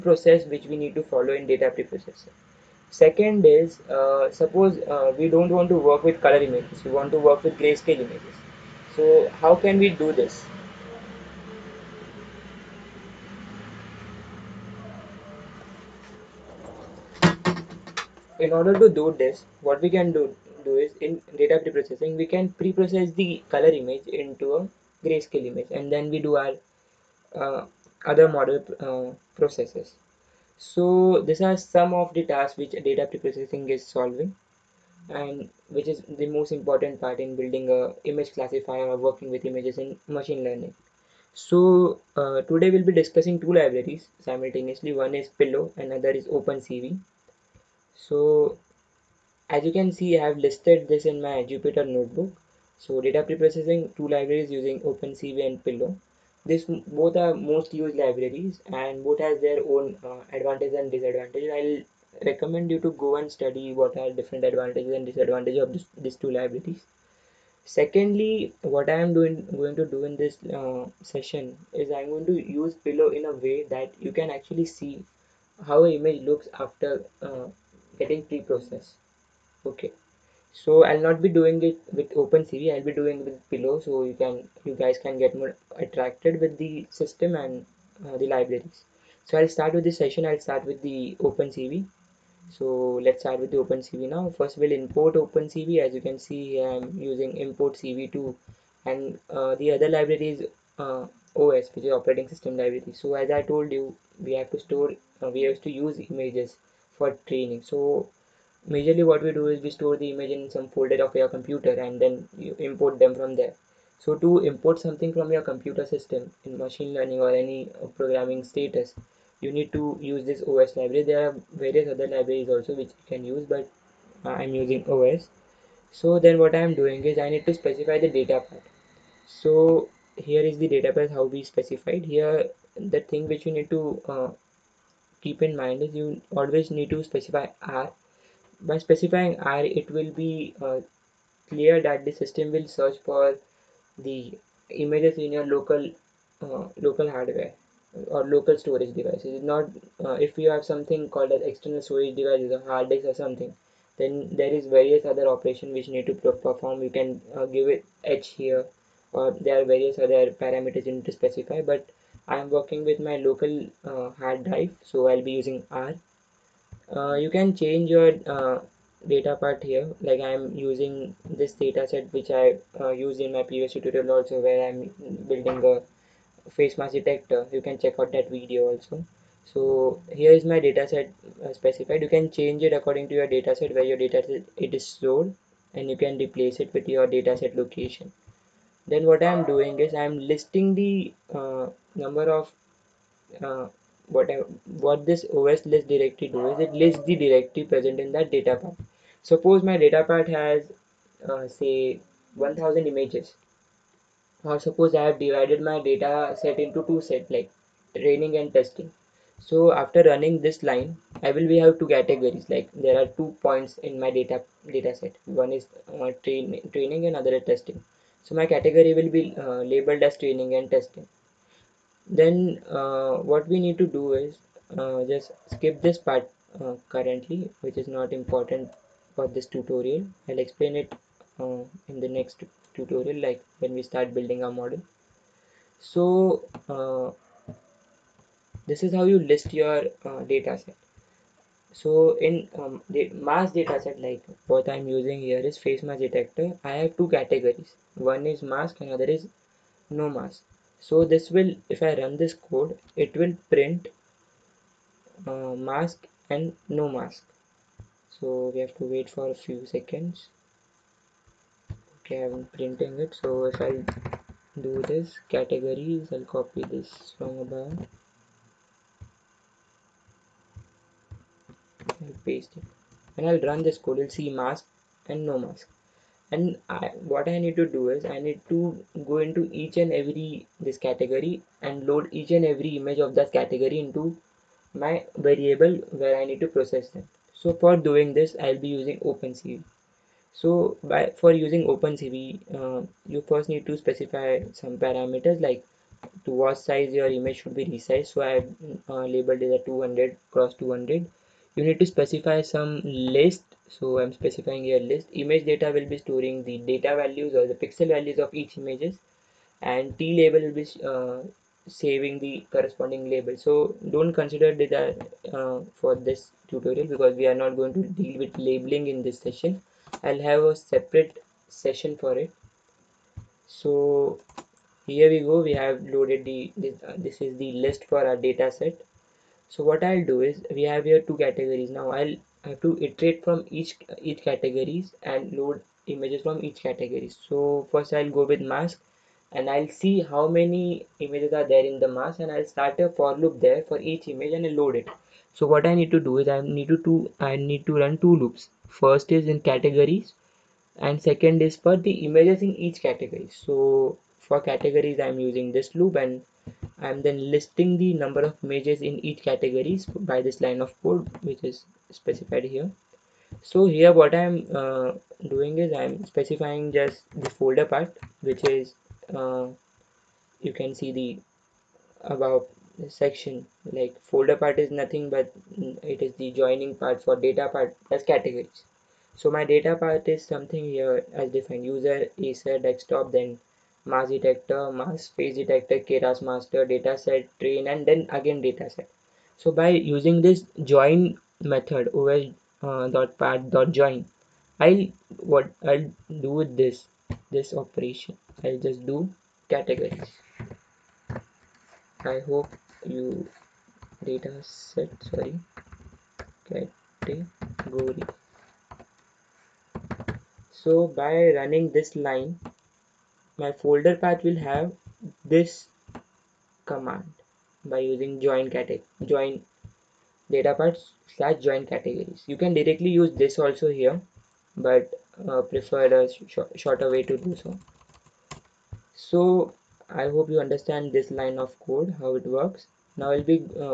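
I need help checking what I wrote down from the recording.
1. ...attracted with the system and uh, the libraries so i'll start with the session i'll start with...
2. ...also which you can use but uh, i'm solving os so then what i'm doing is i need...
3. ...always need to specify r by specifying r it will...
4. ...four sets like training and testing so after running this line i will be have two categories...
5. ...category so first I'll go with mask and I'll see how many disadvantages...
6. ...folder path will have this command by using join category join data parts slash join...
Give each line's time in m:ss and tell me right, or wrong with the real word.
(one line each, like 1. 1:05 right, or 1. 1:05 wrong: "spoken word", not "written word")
1. 1:25 right
2. 2:02 wrong: "using", not "solving"
3. 2:16 right
4. 3:26 wrong: "two", not "four"
5. 5:36 wrong: "images", not "disadvantages"
6. 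6:53 right.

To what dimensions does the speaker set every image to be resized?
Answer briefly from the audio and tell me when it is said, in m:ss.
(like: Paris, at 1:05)
200 x 200, at 4:59.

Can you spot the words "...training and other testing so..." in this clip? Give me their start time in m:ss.
3:36.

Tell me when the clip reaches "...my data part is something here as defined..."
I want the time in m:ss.
6:19.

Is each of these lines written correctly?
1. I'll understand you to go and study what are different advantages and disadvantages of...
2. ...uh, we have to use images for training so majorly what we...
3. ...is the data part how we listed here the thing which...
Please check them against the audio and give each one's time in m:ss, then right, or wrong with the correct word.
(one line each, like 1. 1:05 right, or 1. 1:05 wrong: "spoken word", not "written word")
1. 1:01 wrong: "recommend", not "understand"
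2. 1:45 right
3. 2:10 wrong: "specified", not "listed".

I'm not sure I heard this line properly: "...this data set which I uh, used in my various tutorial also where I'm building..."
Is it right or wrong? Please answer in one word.
wrong.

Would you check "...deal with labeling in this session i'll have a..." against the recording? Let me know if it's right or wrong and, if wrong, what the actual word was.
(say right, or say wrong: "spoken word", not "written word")
right.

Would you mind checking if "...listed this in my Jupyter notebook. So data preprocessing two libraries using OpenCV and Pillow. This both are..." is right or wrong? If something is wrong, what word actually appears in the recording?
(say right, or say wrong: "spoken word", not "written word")
right.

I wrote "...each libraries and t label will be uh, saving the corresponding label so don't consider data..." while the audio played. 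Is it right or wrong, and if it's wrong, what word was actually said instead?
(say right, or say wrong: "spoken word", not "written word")
wrong: "images", not "libraries".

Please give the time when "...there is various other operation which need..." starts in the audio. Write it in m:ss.
2:34.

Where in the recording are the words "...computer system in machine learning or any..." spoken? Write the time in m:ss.
1:55.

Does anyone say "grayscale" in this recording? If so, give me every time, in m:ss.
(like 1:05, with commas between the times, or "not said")
0:07, 0:25.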